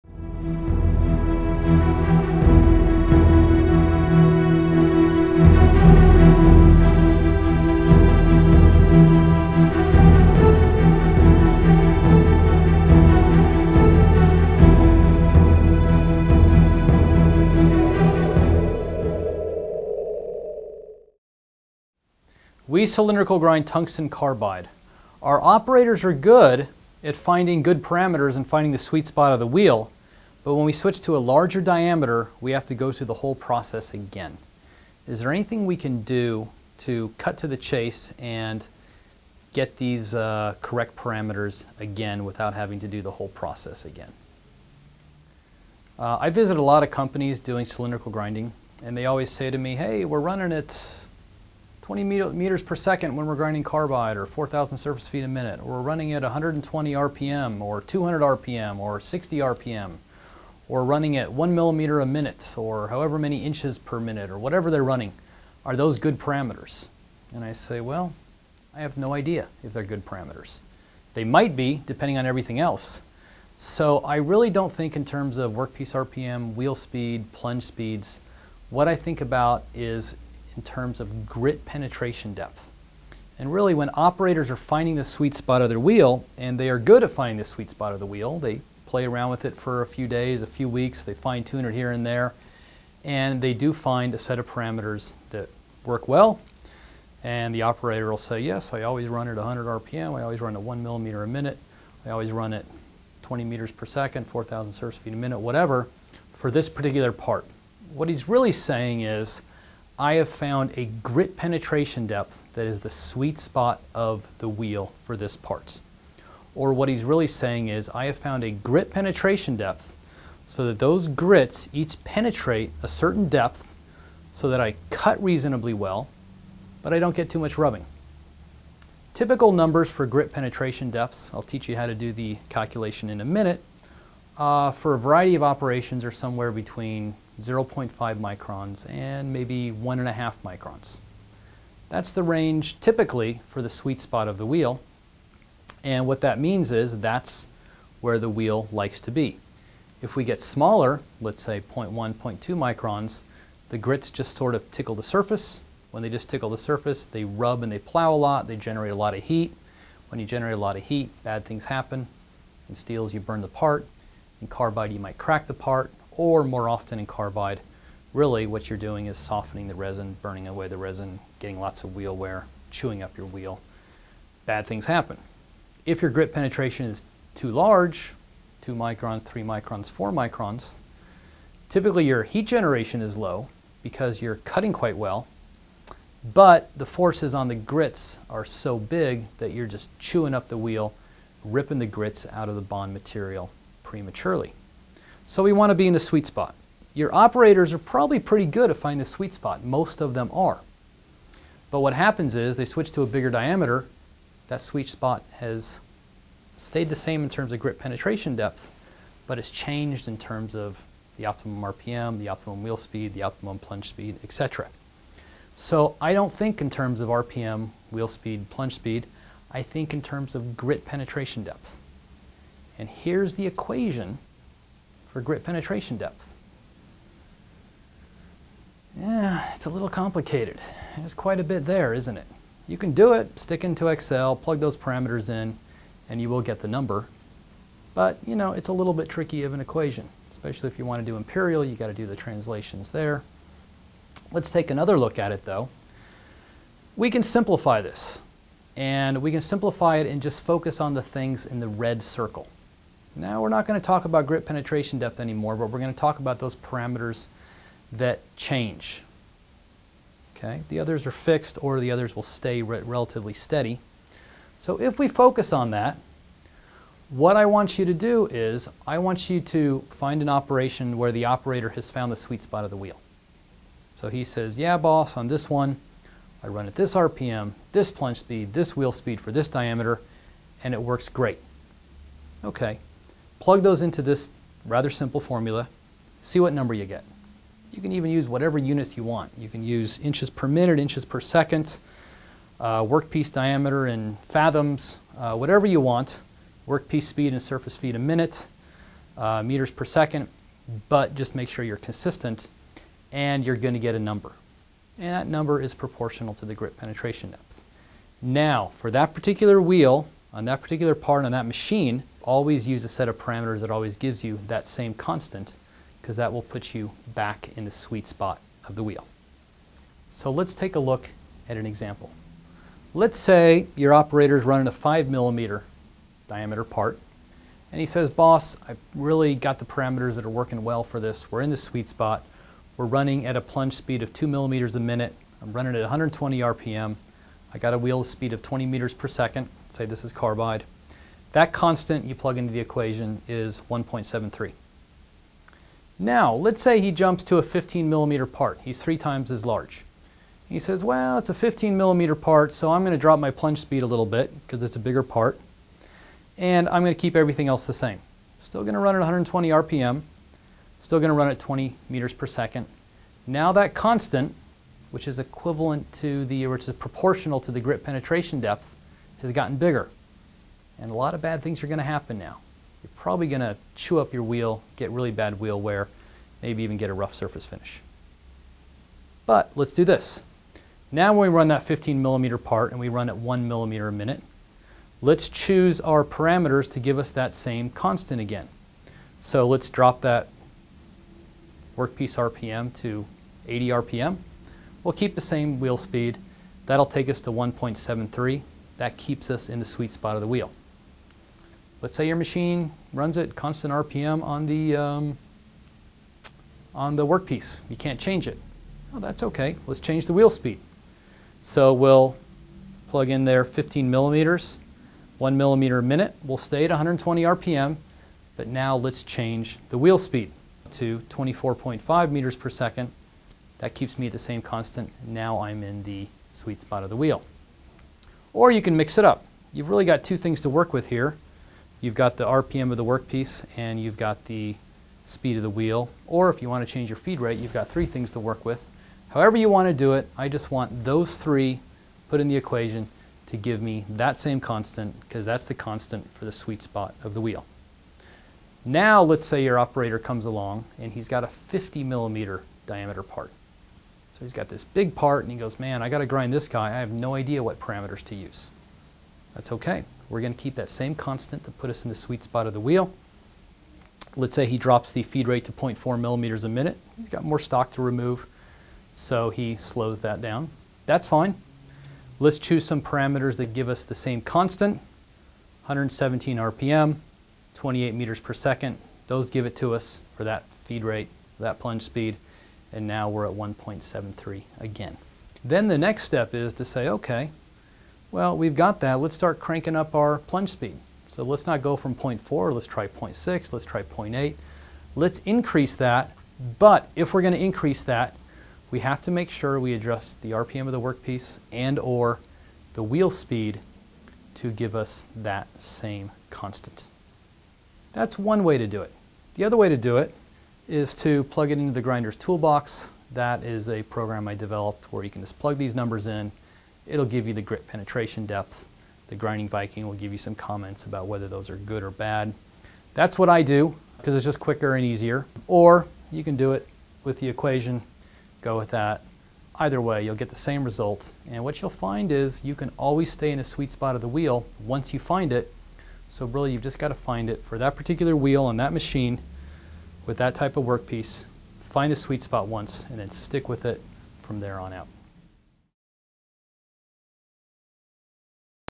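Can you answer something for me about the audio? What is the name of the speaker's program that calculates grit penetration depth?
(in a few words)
the grinder's toolbox.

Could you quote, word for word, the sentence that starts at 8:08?
Let's start cranking up our plunge speed.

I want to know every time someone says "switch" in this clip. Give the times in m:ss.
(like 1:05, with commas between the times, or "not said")
0:30, 3:22.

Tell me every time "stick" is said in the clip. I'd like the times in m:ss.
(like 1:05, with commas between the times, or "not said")
3:53, 9:03.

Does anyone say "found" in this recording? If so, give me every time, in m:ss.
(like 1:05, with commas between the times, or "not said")
1:50, 1:58, 4:31.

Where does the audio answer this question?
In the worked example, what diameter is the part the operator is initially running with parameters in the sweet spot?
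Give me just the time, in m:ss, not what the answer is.
5:24.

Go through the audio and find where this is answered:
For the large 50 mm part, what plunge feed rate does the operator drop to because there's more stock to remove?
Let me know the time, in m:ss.
7:45.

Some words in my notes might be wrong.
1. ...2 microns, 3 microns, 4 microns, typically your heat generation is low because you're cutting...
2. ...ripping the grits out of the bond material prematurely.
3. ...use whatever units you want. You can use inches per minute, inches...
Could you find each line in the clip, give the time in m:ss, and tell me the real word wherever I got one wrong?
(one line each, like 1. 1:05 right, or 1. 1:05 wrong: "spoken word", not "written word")
1. 2:58 right
2. 3:11 right
3. 4:48 right.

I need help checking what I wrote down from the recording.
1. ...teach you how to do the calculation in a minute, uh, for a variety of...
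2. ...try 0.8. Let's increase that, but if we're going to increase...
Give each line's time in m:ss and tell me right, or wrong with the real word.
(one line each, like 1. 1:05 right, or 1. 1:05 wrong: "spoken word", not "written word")
1. 2:11 right
2. 8:13 right.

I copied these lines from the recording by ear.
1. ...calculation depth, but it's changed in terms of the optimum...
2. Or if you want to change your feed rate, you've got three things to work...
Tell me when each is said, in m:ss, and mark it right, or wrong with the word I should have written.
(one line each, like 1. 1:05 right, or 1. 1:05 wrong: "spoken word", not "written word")
1. 3:27 wrong: "penetration", not "calculation"
2. 7:16 right.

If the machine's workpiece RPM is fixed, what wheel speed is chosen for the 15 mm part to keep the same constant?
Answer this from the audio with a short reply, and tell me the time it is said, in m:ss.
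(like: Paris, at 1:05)
24.5 meters per second, at 7:01.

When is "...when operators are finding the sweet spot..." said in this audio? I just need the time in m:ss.
1:23.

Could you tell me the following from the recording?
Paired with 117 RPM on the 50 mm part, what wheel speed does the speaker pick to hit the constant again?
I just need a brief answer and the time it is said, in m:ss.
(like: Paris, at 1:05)
28 meters per second, at 7:57.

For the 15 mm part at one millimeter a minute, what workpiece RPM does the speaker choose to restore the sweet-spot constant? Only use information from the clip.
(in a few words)
80 RPM.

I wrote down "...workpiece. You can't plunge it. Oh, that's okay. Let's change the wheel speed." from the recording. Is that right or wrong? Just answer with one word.
wrong.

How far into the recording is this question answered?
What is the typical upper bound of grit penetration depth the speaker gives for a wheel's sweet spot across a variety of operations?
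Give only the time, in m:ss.
2:19.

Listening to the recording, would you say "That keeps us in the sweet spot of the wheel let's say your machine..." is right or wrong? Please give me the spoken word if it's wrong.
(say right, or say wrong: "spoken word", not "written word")
right.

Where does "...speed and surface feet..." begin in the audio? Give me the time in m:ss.
4:57.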